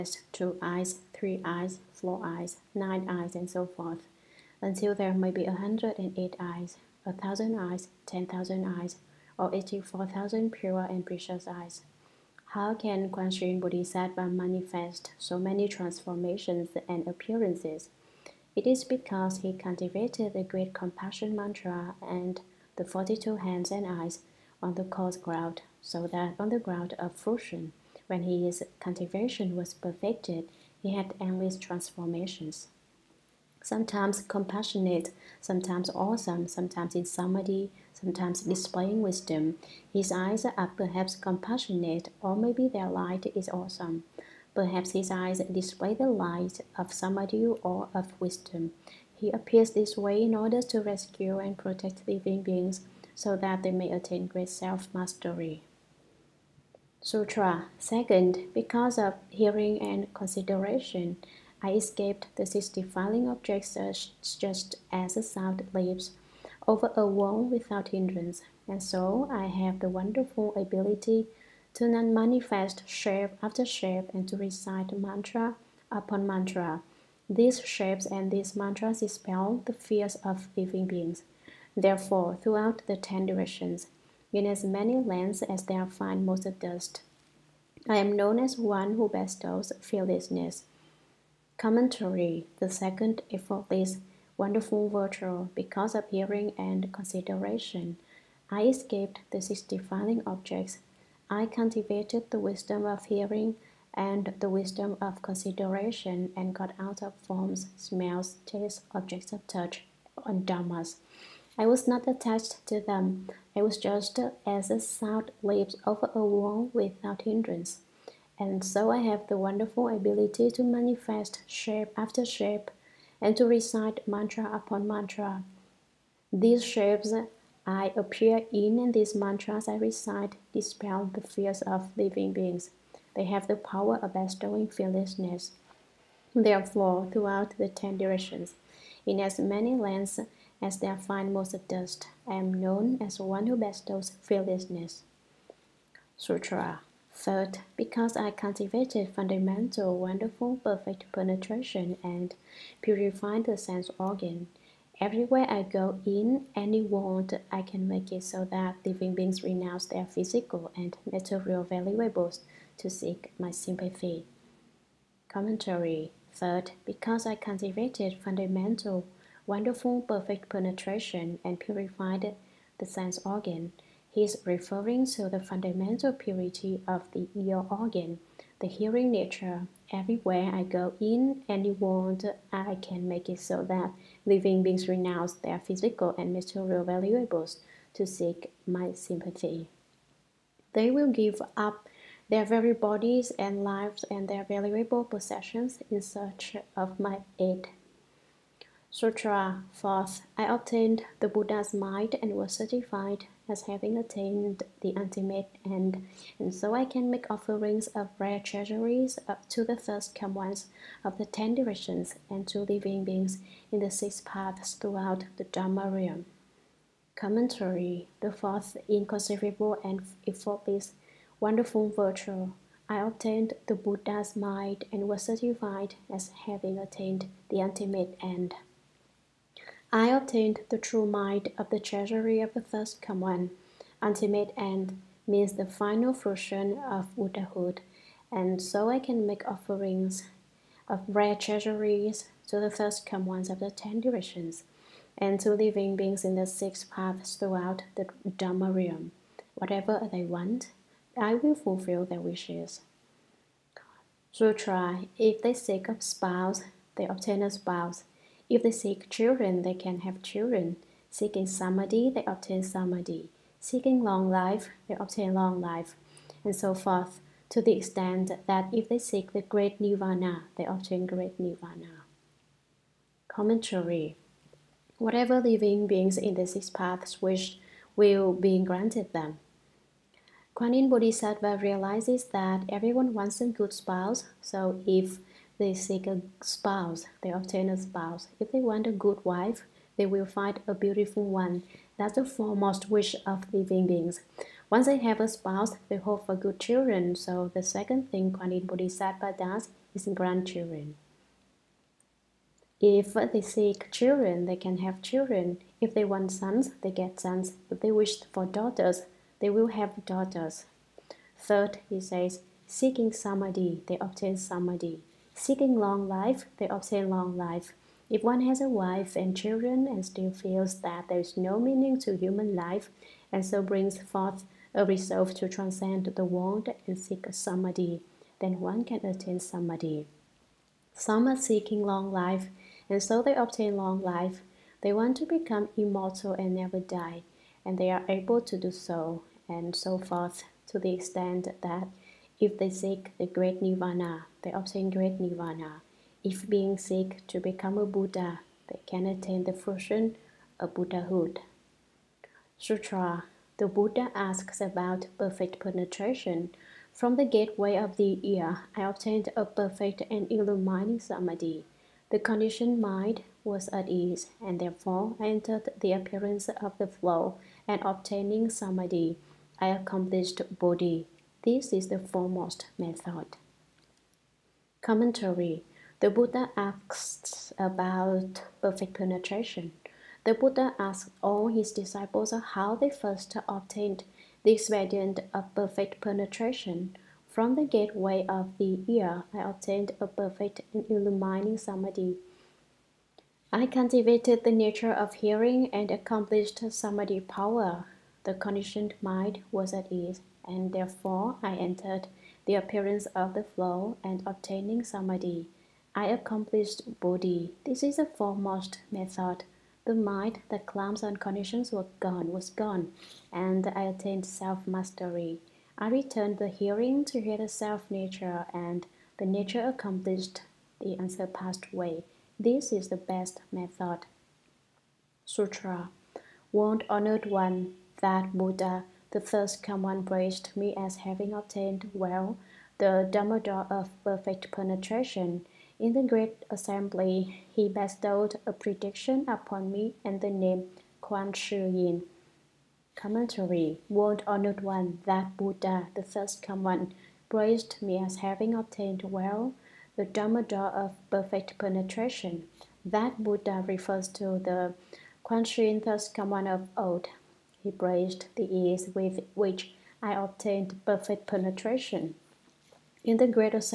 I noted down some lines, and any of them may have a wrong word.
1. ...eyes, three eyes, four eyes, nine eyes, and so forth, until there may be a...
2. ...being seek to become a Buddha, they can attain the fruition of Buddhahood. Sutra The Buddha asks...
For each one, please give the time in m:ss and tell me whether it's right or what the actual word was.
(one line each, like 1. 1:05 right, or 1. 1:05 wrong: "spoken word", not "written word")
1. 0:00 right
2. 5:46 right.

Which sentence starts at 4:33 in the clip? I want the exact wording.
Commentary Whatever living beings in the six paths wish will be granted them.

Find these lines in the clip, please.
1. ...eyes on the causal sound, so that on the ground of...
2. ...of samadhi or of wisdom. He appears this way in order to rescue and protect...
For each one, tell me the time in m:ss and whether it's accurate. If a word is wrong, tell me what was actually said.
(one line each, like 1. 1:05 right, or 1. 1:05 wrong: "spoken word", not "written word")
1. 0:23 wrong: "ground", not "sound"
2. 0:46 right.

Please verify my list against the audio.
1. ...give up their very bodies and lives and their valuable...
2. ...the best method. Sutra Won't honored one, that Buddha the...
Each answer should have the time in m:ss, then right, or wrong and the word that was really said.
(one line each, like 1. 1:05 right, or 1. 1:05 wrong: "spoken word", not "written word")
1. 3:11 right
2. 7:02 right.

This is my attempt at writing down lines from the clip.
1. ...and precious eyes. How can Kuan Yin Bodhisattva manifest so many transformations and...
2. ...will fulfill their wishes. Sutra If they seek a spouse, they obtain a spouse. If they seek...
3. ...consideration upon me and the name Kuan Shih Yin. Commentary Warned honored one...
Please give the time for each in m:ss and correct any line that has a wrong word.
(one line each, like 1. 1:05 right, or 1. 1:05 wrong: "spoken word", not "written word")
1. 0:10 right
2. 4:11 right
3. 7:18 wrong: "prediction", not "consideration".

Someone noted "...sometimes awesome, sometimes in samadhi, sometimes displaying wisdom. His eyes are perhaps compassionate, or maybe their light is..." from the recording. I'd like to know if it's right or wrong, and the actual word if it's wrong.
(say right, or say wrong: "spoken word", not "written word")
right.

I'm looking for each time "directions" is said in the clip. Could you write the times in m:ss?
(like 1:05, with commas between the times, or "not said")
1:23, 2:17, 3:31, 4:03.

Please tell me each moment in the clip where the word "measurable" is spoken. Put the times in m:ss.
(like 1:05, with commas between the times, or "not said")
not said.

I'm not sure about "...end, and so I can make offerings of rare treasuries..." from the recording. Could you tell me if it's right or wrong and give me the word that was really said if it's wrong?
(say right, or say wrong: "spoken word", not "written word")
right.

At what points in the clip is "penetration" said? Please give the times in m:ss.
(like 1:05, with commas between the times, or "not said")
2:31, 2:50, 5:55, 6:18, 6:26, 7:14, 7:31, 7:41.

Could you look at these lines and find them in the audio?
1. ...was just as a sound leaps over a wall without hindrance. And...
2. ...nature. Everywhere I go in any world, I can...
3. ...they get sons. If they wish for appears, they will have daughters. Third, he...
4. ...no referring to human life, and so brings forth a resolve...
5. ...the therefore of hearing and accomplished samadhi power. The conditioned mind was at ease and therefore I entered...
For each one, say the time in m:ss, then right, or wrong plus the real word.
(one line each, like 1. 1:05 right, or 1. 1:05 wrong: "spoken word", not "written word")
1. 1:53 right
2. 2:59 right
3. 5:06 wrong: "daughters", not "appears"
4. 5:21 wrong: "meaning", not "referring"
5. 6:34 wrong: "nature", not "therefore".